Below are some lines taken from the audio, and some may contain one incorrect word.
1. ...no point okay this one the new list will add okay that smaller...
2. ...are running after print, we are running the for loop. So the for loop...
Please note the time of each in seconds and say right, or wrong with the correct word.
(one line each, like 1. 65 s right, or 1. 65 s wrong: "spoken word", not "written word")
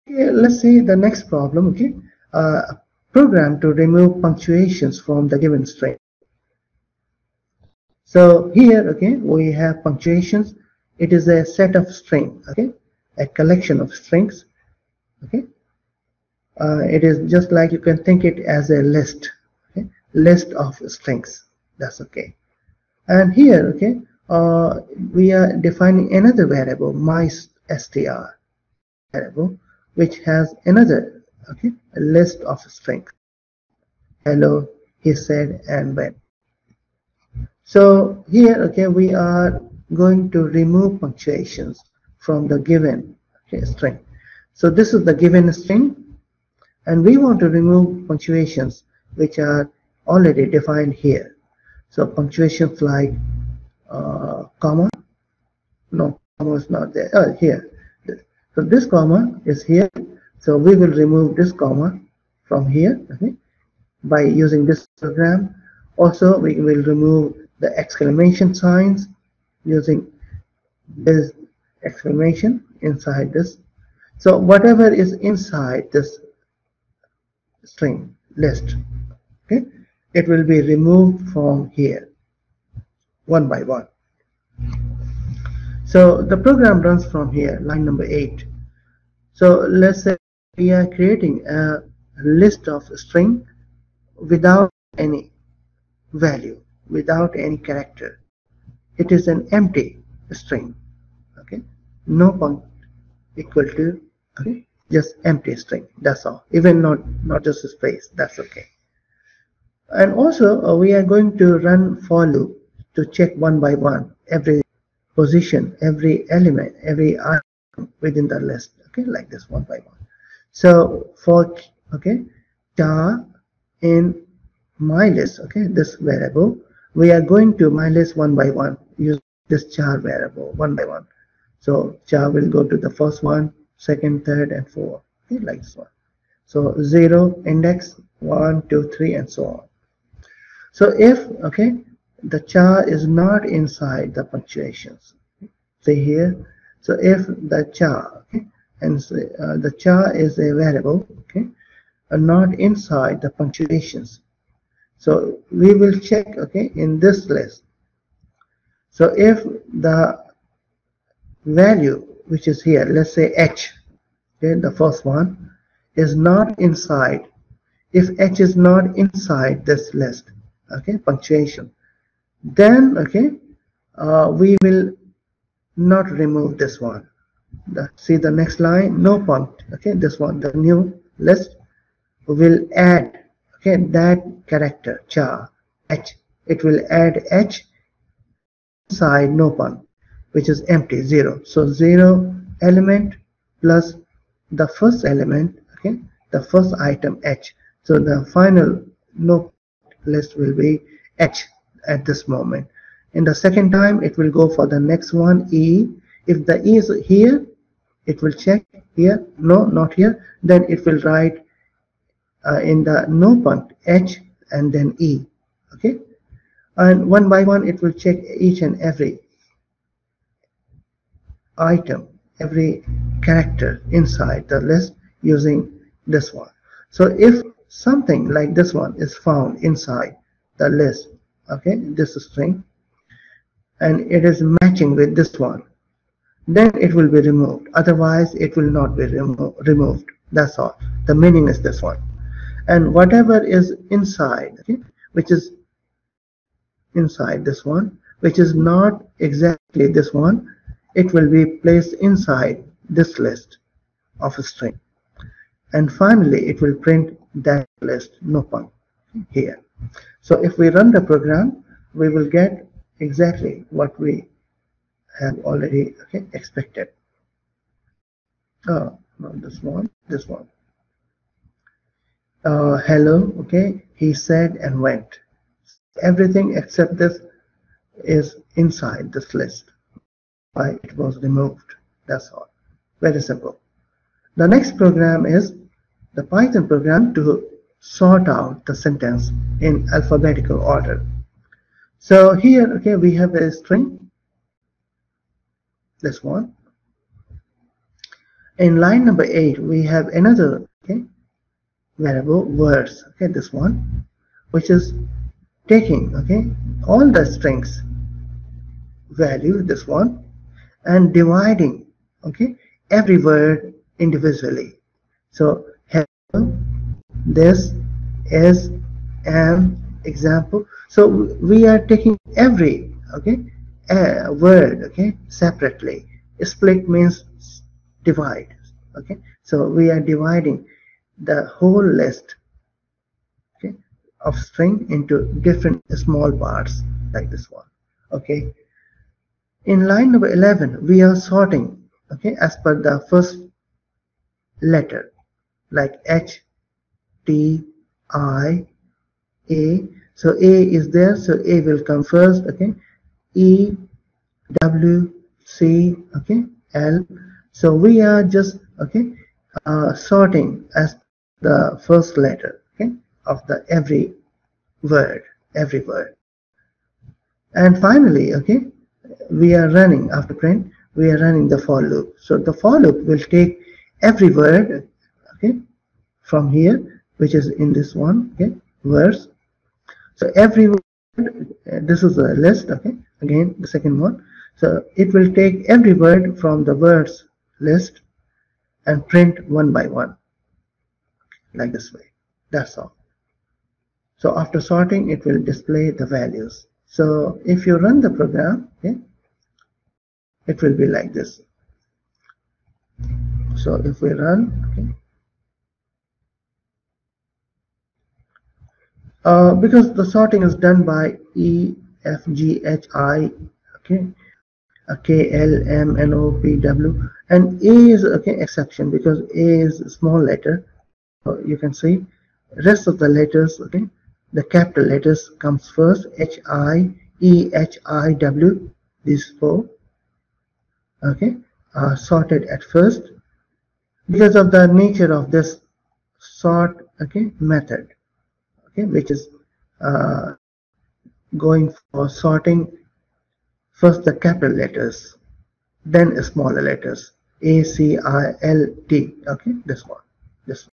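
1. 179 s wrong: "character", not "smaller"
2. 369 s right.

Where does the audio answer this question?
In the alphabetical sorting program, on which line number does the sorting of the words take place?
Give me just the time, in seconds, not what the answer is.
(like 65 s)
339 s.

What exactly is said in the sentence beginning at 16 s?
Uh, it is just like you can think it as a list, okay, list of strings.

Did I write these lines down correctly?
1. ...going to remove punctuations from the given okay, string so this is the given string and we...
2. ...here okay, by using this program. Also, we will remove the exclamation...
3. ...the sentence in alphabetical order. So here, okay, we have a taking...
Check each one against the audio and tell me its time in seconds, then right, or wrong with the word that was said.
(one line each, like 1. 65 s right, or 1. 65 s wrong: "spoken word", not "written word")
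1. 39 s right
2. 62 s right
3. 288 s wrong: "string", not "taking".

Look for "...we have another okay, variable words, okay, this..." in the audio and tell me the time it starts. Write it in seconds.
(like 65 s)
299 s.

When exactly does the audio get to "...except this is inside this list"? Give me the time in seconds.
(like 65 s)
276 s.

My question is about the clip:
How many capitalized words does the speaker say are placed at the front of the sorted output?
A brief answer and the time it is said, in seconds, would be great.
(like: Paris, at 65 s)
4, at 429 s.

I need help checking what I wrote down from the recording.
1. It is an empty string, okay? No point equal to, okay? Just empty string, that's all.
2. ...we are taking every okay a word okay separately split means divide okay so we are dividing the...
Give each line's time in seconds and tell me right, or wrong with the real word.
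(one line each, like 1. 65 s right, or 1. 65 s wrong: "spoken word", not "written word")
1. 98 s right
2. 321 s right.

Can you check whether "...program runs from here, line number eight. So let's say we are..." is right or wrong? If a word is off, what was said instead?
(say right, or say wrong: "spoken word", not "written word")
right.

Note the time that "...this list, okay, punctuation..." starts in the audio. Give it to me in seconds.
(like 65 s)
169 s.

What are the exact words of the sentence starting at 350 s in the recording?
So A is there, so A will come first, okay?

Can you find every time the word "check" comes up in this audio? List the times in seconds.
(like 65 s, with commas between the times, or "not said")
113 s, 155 s, 208 s, 217 s.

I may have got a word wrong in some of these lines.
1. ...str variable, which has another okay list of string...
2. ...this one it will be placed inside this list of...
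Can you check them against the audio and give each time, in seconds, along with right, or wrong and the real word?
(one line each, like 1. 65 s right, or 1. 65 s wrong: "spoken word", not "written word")
1. 27 s right
2. 249 s right.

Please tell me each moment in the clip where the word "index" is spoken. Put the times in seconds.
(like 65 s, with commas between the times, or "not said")
137 s.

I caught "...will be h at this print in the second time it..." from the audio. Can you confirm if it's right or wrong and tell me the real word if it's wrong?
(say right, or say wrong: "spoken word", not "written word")
wrong: "moment", not "print".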